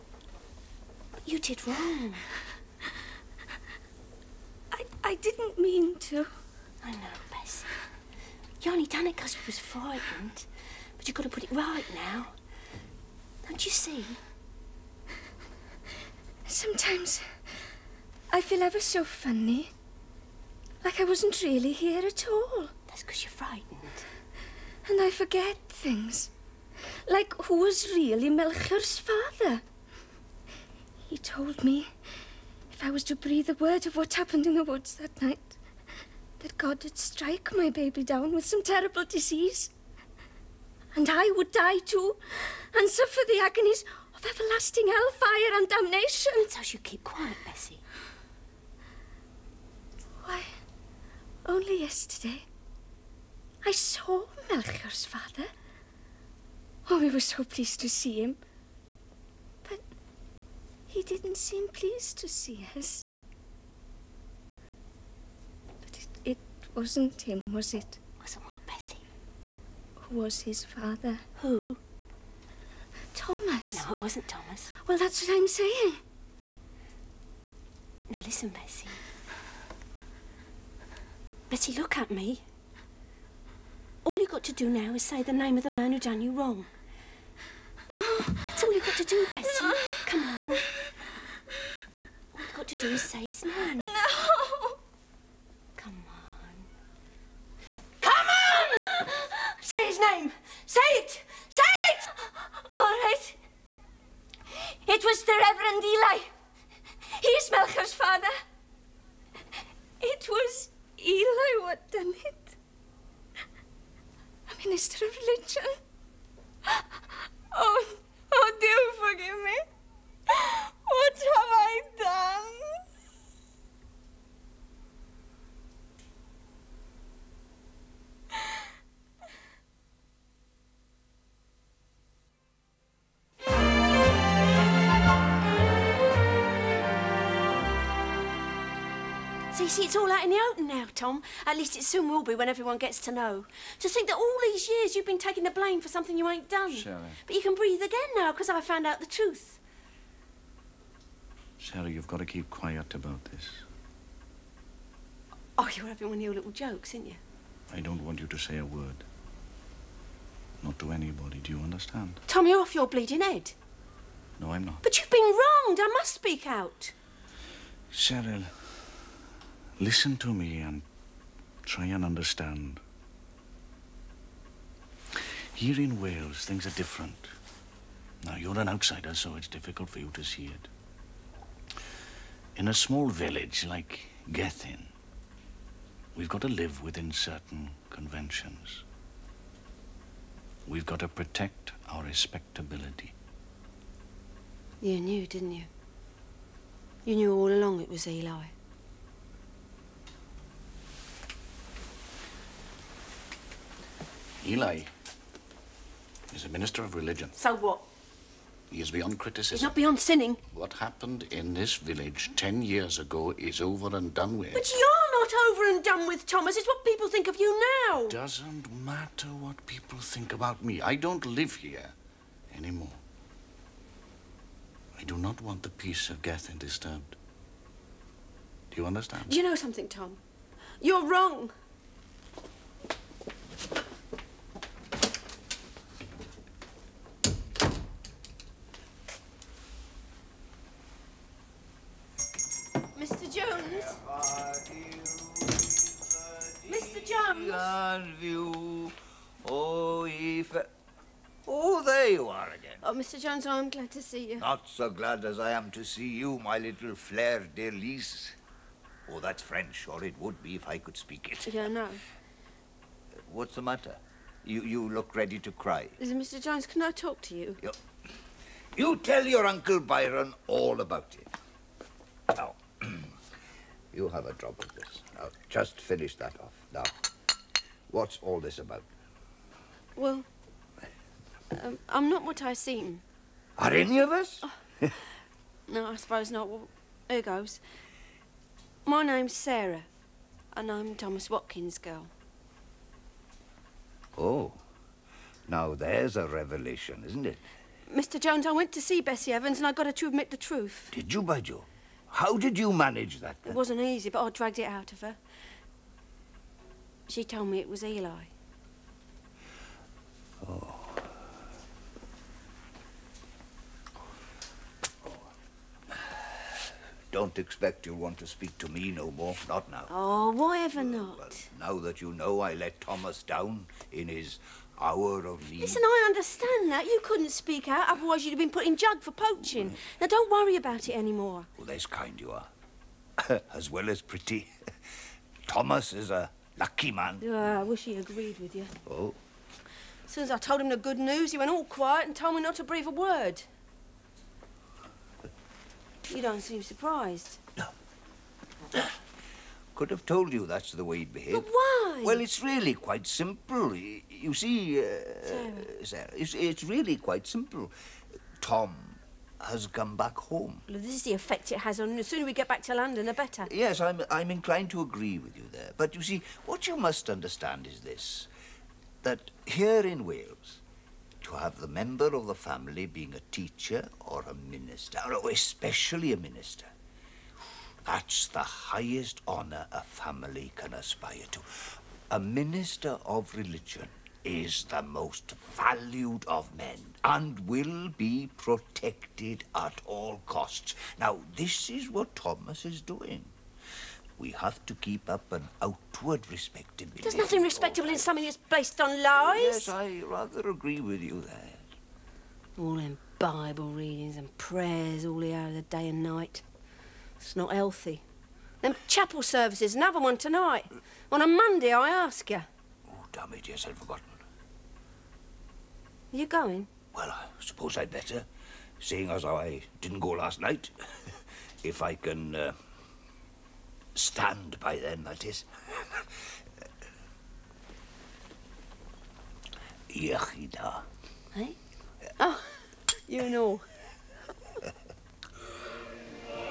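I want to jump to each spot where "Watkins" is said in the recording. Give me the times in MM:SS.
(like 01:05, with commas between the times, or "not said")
04:51.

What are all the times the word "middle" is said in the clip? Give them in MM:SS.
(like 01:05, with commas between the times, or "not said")
not said.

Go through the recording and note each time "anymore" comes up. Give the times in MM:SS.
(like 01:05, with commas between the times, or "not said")
03:42, 05:30.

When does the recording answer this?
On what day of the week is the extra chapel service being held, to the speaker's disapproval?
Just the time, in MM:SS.
06:51.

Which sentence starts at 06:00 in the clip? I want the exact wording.
Well, this is the effect it has on.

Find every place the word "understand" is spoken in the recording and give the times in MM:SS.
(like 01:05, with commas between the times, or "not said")
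02:41, 02:52, 03:48, 05:26, 06:07.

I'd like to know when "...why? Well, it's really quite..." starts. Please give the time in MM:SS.
05:51.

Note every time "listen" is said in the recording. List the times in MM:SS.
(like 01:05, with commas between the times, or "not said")
01:18, 02:49, 05:25.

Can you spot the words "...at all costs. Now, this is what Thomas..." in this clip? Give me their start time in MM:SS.
06:29.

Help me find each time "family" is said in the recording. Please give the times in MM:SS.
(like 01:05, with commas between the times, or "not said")
06:12, 06:19.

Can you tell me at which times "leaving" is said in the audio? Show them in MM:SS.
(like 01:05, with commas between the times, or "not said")
not said.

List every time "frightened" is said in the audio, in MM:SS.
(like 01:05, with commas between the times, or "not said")
00:09, 00:23.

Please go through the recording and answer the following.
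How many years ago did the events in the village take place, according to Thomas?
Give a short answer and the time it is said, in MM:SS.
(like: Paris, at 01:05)
10, at 03:32.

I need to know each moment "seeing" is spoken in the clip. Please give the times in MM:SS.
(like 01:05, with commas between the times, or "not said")
06:58.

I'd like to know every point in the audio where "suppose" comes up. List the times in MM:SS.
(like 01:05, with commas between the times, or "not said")
04:45, 06:57.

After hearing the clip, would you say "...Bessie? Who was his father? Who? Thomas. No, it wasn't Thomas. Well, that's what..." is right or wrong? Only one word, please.
right.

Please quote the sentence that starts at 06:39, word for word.
Yes, I rather agree with you there.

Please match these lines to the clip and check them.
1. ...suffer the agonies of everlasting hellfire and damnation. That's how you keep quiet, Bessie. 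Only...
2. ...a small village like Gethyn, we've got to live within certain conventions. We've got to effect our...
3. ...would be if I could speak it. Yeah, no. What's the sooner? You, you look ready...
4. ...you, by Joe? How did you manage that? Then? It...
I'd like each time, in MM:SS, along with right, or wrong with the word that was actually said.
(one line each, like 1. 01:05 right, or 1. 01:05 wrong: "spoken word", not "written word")
1. 00:42 right
2. 03:02 wrong: "protect", not "effect"
3. 04:20 wrong: "matter", not "sooner"
4. 05:01 right.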